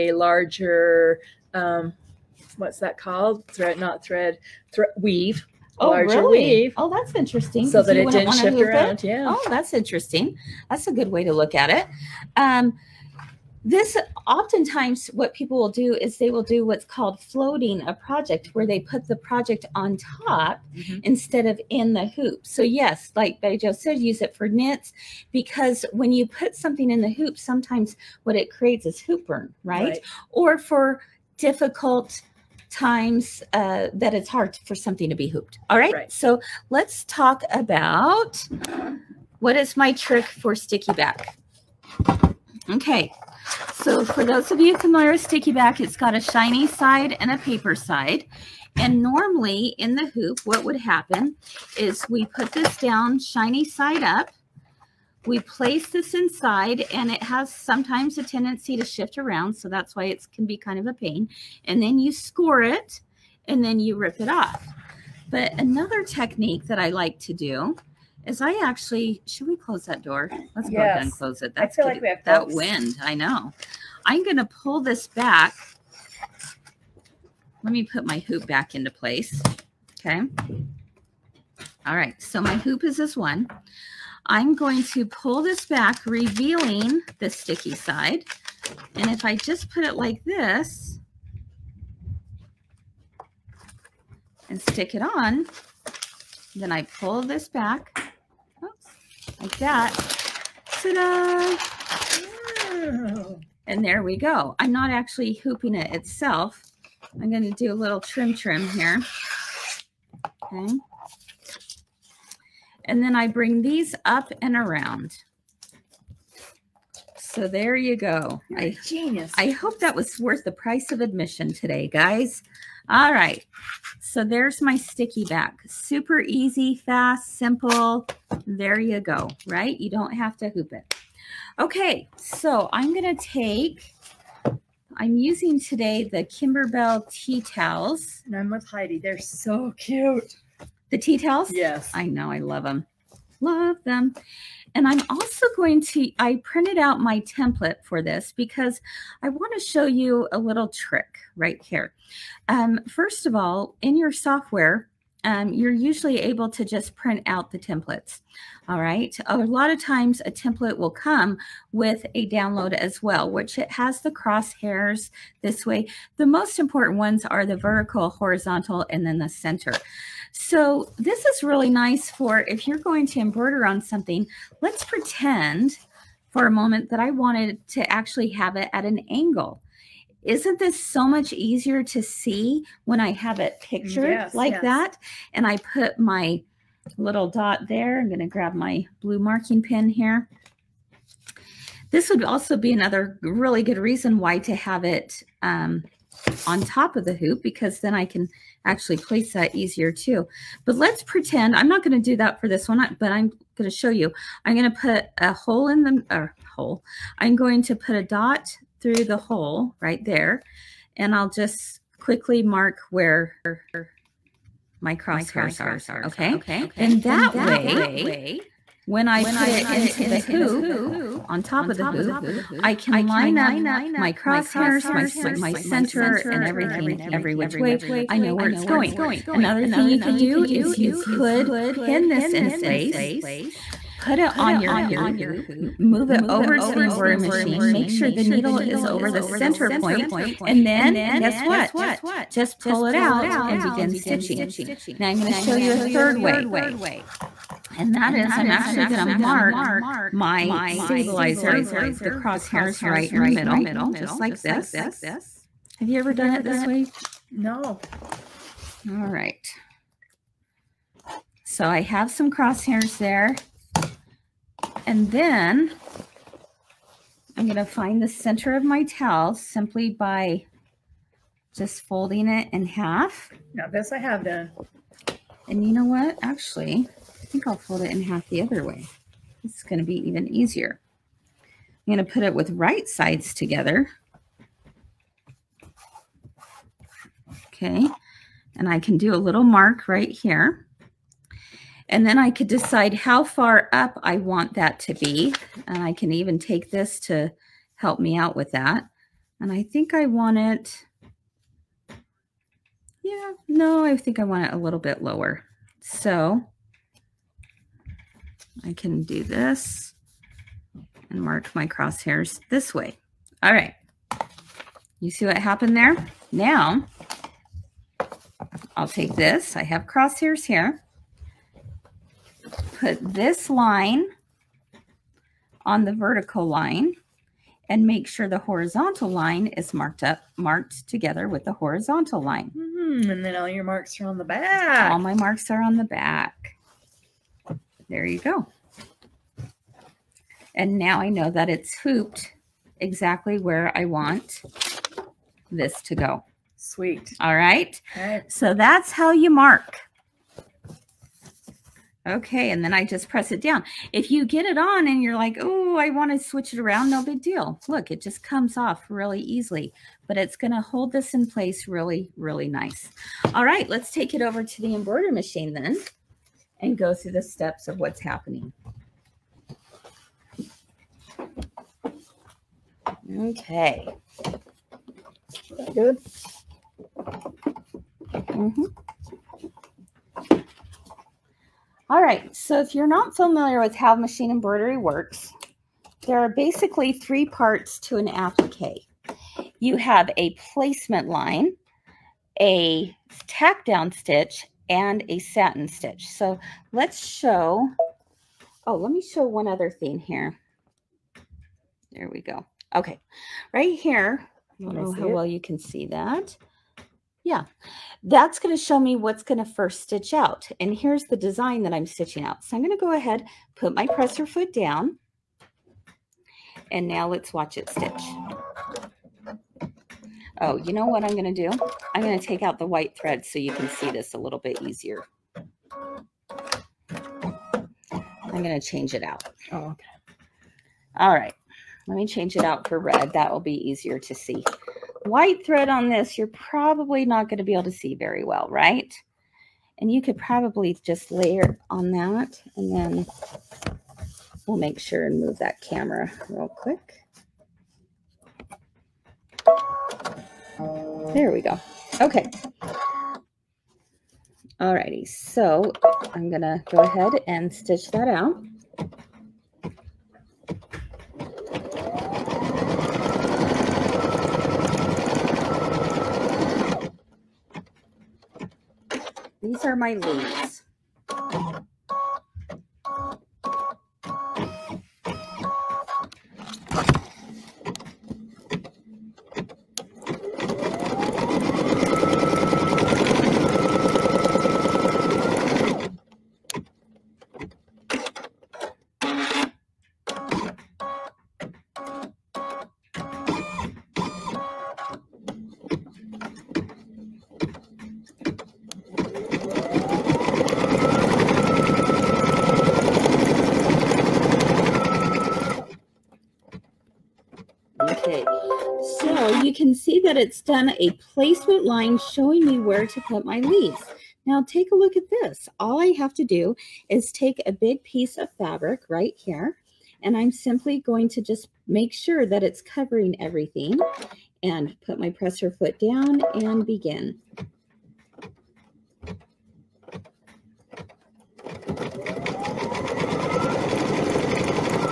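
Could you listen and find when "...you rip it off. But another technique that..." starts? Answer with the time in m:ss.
1:03.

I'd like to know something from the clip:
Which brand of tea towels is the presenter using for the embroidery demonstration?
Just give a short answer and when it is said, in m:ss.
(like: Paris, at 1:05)
Kimberbell, at 2:16.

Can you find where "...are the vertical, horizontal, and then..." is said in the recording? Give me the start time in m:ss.
2:47.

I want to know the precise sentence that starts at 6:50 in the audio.
And here's the design that I'm stitching out.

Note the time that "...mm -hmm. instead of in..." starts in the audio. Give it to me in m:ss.
0:20.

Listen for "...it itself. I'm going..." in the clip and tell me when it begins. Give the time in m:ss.
1:45.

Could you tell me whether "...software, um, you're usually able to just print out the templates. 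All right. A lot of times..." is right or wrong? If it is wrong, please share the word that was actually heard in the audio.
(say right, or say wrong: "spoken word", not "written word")
right.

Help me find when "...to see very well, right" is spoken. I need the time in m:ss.
7:17.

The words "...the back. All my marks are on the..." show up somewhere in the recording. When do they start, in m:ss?
5:34.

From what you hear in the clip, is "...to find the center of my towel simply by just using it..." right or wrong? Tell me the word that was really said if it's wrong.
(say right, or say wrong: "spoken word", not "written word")
wrong: "folding", not "using".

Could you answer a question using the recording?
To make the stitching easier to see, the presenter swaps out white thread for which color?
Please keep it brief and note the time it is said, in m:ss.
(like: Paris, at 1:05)
red, at 7:12.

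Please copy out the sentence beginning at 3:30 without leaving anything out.
And I'll just quickly mark where my crosshairs are.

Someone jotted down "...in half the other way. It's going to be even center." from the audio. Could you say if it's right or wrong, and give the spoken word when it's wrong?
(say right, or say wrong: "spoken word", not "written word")
wrong: "easier", not "center".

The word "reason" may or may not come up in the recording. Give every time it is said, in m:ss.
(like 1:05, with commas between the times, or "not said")
3:13.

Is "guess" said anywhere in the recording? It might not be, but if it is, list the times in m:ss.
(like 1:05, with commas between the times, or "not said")
4:01.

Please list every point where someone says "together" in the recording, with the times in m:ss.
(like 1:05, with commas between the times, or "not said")
4:43, 5:30.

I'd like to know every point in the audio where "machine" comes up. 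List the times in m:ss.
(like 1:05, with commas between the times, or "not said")
3:57, 6:05, 6:23.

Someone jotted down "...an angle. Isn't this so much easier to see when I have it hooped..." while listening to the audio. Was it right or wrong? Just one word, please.
wrong.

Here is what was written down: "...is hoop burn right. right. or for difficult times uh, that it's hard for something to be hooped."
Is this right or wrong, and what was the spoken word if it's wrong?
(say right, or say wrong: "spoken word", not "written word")
right.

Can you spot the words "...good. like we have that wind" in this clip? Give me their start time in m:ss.
1:11.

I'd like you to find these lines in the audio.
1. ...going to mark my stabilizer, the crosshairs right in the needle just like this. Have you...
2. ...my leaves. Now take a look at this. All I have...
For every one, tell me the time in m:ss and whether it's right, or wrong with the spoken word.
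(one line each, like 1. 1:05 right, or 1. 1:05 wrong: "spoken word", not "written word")
1. 4:08 wrong: "middle", not "needle"
2. 8:33 right.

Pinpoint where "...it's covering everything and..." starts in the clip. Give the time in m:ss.
8:42.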